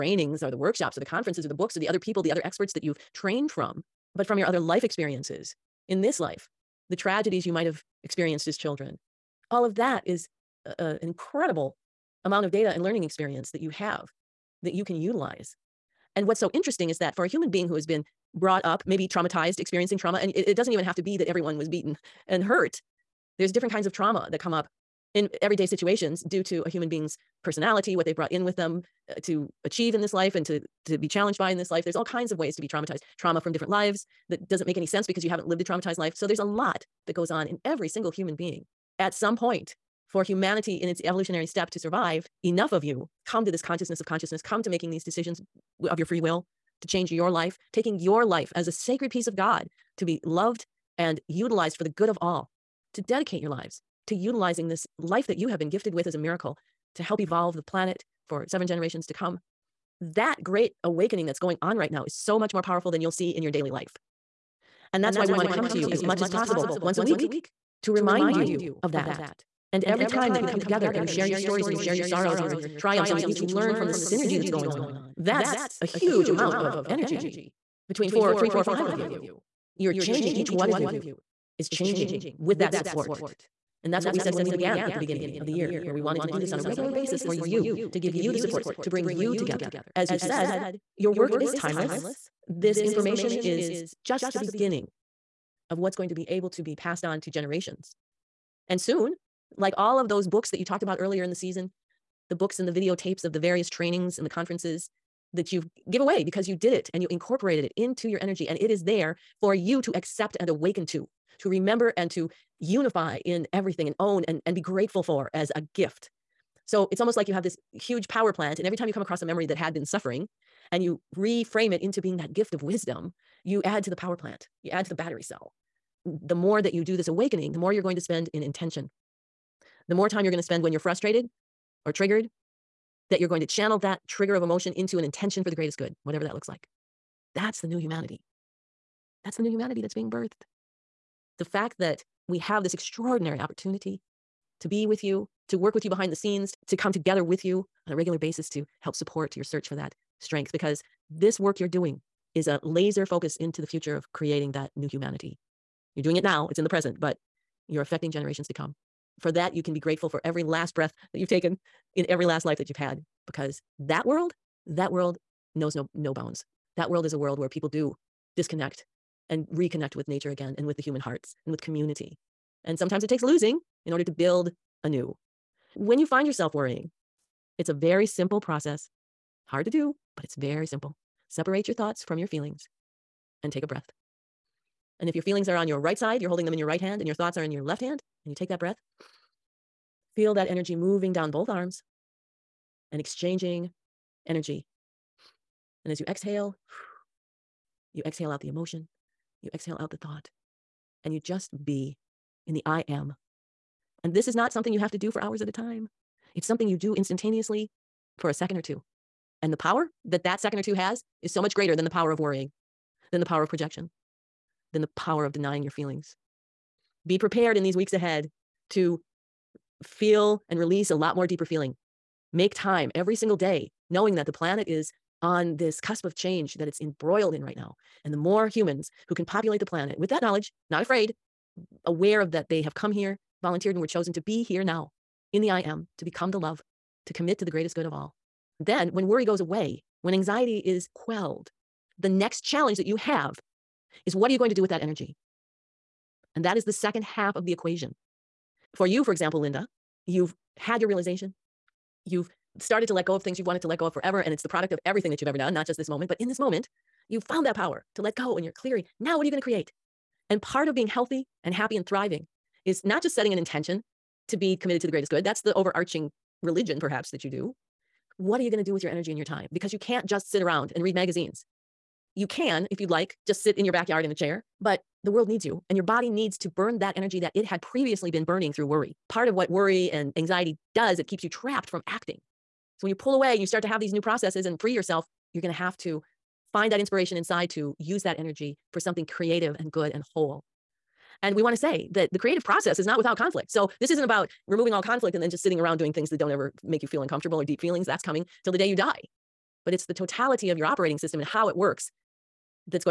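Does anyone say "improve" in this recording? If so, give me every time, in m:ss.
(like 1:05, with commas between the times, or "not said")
not said.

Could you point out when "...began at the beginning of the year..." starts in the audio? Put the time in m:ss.
1:24.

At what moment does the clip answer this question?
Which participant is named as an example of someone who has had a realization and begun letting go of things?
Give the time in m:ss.
4:09.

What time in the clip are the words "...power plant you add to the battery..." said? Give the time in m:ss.
2:03.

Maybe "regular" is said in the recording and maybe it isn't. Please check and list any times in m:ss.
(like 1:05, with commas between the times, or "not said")
1:26, 2:27.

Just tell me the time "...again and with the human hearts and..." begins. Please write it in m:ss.
2:50.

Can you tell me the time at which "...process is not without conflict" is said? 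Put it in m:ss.
4:52.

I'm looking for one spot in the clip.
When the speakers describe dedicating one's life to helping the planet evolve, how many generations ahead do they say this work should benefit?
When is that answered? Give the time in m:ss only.
0:58.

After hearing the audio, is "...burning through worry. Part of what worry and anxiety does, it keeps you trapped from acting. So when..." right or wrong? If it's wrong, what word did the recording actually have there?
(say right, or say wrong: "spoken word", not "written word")
right.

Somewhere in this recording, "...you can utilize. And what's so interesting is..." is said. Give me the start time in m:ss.
0:14.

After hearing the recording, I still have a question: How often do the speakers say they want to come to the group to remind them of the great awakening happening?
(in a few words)
Once a week.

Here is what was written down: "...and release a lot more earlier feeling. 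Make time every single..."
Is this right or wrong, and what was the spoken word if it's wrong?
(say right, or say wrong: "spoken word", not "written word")
wrong: "deeper", not "earlier".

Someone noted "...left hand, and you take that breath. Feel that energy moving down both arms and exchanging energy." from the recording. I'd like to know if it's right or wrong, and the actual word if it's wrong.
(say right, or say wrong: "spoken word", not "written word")
right.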